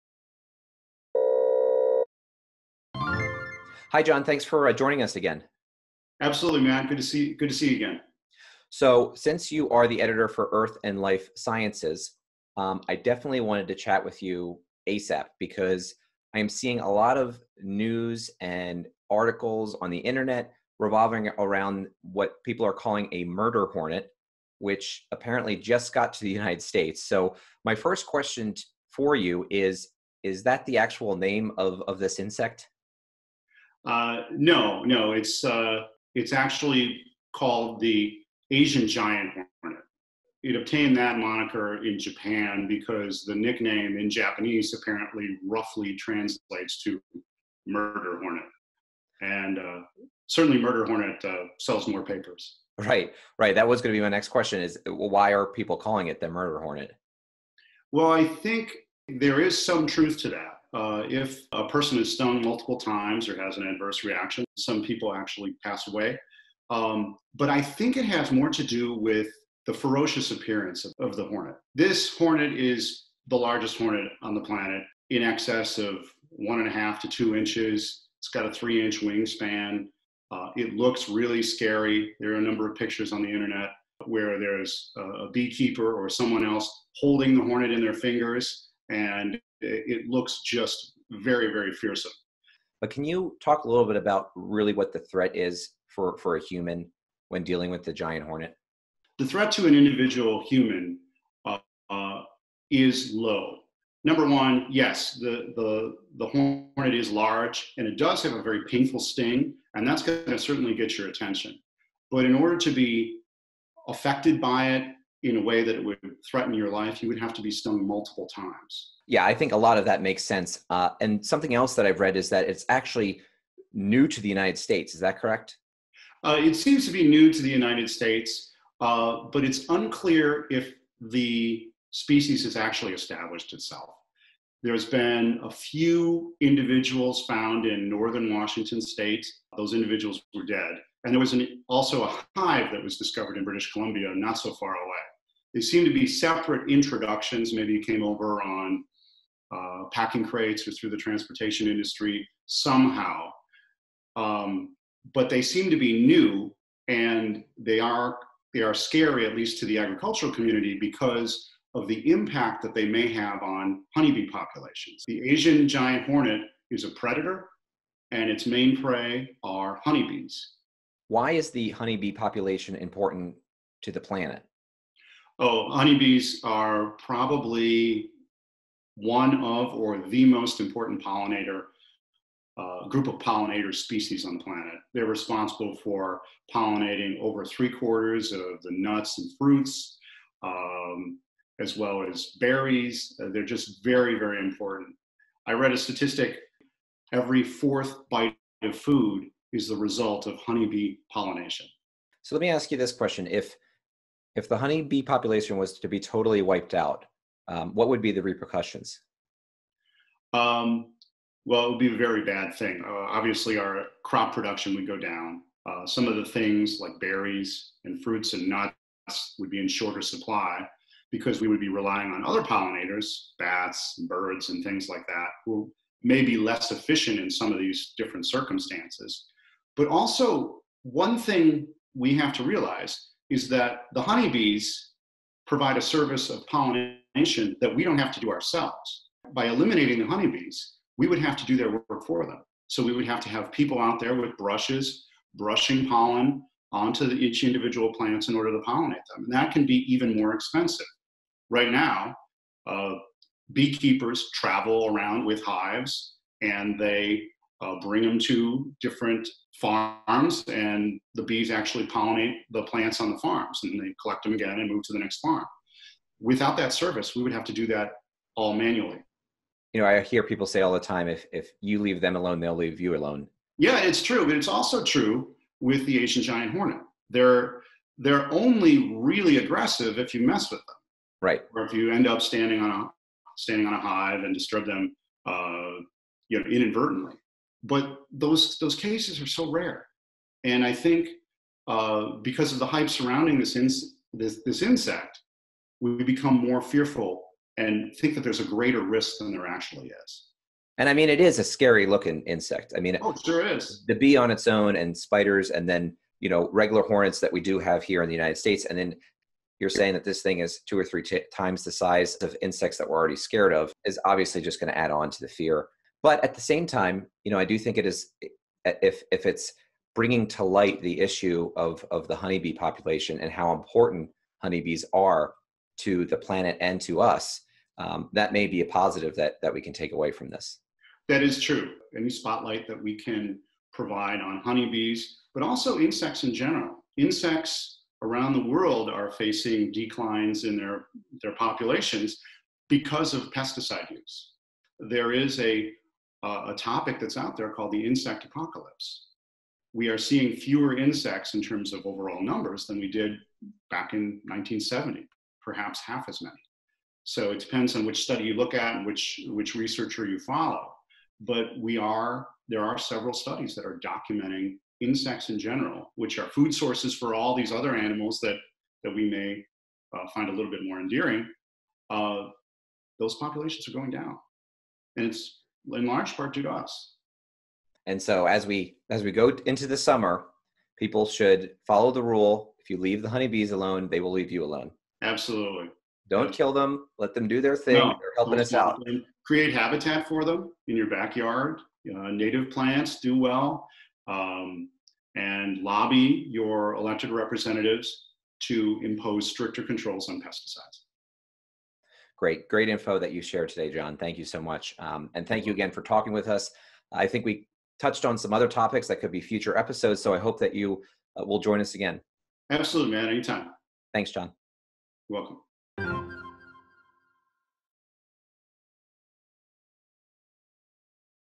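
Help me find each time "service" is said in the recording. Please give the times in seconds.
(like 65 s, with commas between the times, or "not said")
235 s, 266 s.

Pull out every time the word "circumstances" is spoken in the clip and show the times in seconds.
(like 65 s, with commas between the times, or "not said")
228 s.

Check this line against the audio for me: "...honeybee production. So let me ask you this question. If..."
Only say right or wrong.
wrong.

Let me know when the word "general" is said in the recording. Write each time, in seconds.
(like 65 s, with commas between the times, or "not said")
336 s, 365 s.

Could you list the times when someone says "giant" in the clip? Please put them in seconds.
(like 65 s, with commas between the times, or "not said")
38 s, 97 s, 165 s, 276 s.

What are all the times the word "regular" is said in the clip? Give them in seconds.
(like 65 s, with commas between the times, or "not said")
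306 s.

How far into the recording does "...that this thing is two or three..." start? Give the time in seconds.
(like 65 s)
309 s.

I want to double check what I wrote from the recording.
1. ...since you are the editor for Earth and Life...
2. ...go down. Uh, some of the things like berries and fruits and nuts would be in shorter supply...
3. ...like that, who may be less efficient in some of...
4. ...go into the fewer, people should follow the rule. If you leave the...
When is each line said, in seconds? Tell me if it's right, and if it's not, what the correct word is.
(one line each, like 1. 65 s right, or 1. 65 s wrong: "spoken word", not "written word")
1. 9 s right
2. 214 s right
3. 224 s right
4. 379 s wrong: "summer", not "fewer".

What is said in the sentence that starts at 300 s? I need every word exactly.
And I mean, it is a scary looking insect.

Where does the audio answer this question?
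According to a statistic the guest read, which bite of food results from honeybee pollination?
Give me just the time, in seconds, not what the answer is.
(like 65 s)
197 s.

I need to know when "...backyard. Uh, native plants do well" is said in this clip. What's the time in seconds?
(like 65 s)
390 s.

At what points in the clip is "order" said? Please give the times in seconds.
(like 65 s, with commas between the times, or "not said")
112 s, 248 s.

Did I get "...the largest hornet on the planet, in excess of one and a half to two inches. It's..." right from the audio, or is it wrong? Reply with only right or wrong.
right.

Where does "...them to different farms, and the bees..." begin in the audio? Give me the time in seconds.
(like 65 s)
258 s.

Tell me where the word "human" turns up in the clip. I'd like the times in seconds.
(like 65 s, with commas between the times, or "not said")
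96 s, 100 s.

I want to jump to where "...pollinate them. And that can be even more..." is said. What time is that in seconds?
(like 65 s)
248 s.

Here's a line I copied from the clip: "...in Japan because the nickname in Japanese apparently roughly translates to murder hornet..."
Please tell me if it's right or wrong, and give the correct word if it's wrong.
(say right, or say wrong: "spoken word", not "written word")
right.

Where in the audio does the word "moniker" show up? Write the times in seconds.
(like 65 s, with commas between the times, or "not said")
41 s.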